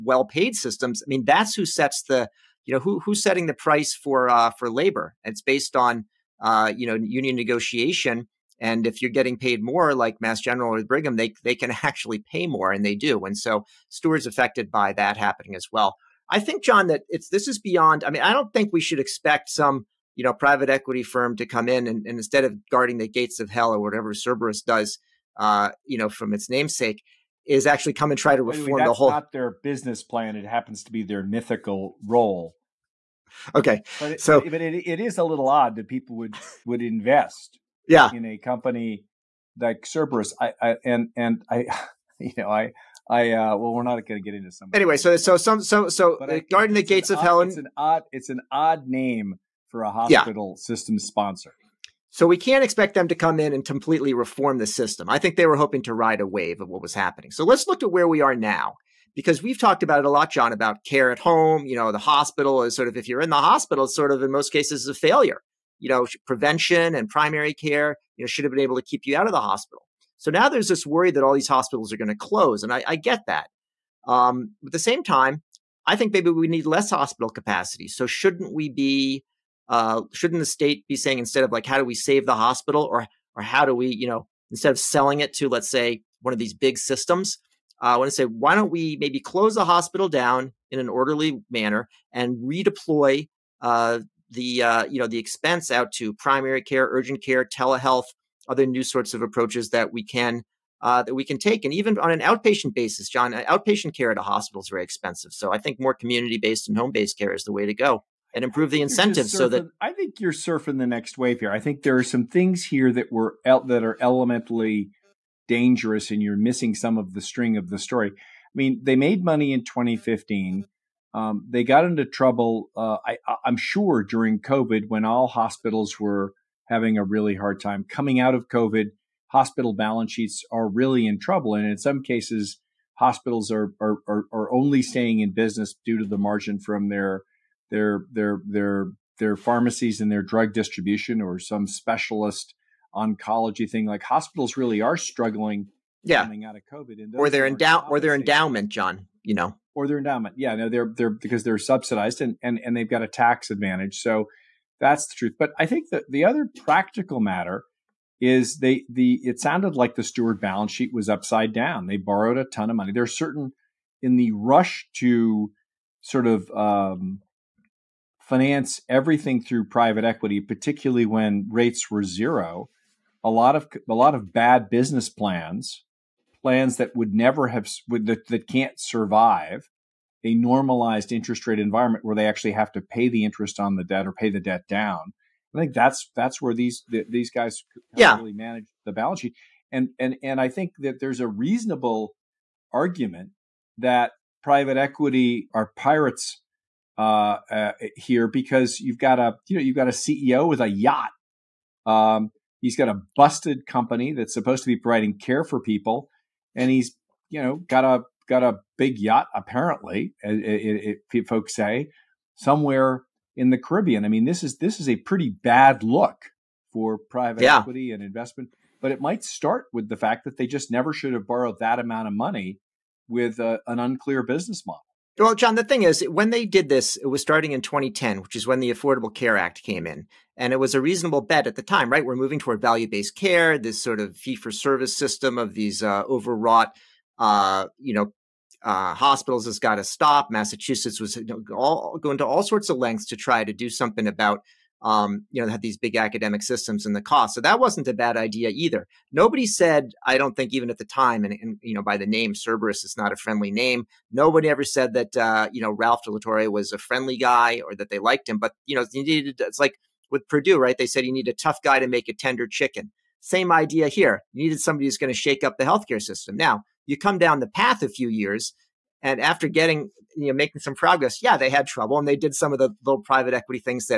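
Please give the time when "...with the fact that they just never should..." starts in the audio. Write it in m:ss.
3:39.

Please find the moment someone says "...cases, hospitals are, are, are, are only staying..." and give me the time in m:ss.
2:12.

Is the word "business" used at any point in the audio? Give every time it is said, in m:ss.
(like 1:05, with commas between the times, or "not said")
0:29, 2:15, 2:54, 3:44.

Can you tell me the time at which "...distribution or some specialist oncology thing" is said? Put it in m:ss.
2:20.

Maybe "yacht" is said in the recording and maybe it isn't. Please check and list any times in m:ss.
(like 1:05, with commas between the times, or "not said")
3:20, 3:28.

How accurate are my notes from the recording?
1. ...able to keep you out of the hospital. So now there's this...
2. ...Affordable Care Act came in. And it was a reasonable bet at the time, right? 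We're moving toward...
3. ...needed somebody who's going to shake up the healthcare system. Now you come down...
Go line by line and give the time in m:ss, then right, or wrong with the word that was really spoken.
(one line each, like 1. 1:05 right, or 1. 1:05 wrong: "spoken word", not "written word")
1. 1:08 right
2. 3:48 right
3. 4:24 right.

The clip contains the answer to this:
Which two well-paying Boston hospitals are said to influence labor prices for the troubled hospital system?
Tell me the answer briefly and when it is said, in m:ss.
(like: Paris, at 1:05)
Mass General or Brigham, at 0:10.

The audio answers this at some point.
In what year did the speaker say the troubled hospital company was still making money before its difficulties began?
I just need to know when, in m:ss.
1:59.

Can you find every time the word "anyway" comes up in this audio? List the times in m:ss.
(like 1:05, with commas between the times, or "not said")
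0:28, 0:44.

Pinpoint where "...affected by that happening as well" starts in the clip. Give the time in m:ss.
0:14.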